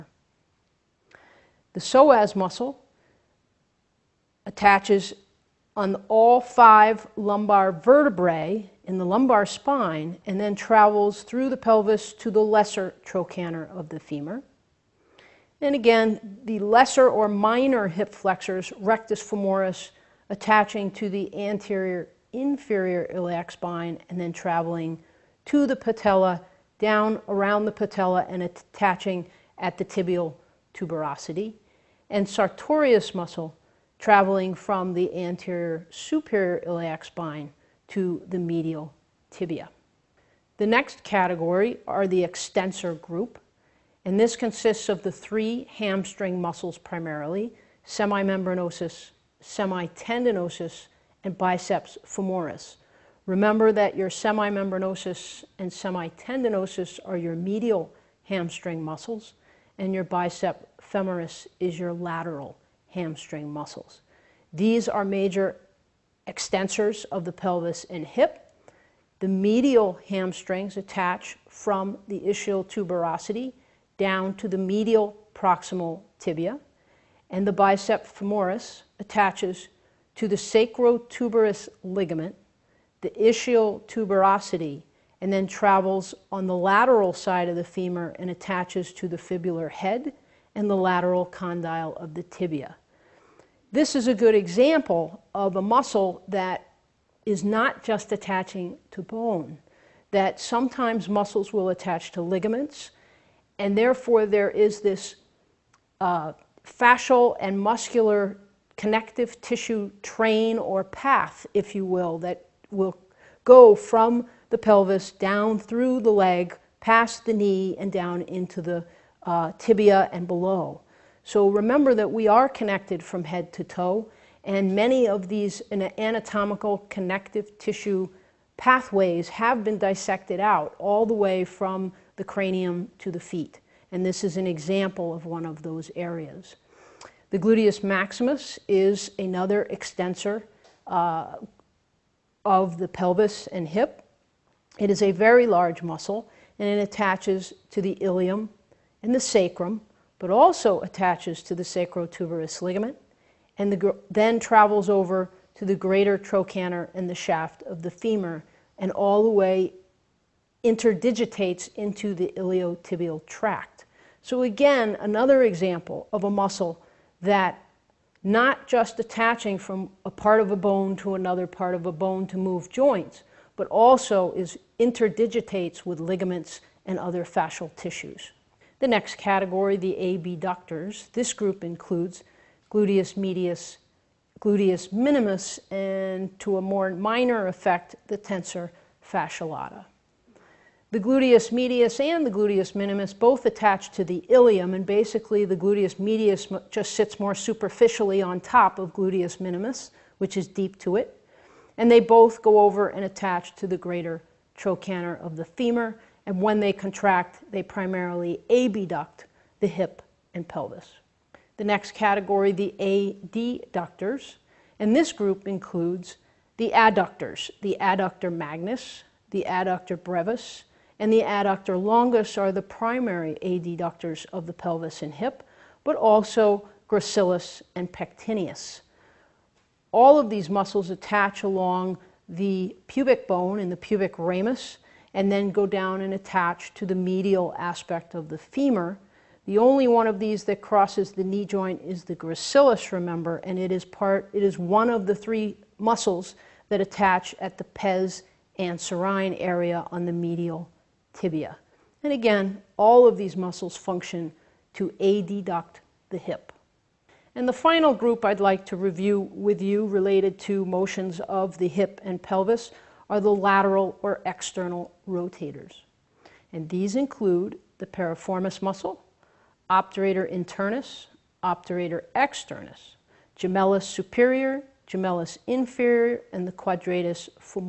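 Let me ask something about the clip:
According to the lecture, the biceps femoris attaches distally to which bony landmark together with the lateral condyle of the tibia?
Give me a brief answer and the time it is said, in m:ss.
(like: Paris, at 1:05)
fibular head, at 1:29.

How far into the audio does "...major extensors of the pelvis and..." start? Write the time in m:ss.
1:05.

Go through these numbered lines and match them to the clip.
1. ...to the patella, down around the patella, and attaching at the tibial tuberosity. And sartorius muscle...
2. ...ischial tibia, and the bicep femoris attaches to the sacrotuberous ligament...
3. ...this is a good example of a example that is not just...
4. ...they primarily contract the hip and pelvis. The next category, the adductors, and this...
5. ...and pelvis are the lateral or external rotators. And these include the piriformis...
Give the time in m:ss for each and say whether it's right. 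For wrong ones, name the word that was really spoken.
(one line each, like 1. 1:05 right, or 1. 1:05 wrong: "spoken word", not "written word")
1. 0:25 right
2. 1:15 wrong: "proximal", not "ischial"
3. 1:33 wrong: "muscle", not "example"
4. 3:27 wrong: "abduct", not "contract"
5. 4:22 right.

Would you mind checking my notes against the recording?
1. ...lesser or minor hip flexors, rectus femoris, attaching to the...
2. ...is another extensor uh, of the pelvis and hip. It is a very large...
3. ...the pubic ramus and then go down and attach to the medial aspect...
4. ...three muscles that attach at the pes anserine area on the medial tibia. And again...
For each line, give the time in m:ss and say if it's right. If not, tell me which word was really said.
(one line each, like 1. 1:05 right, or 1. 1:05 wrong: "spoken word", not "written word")
1. 0:16 right
2. 2:18 right
3. 3:53 right
4. 4:05 right.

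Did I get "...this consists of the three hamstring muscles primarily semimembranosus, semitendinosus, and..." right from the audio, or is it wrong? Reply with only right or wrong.
right.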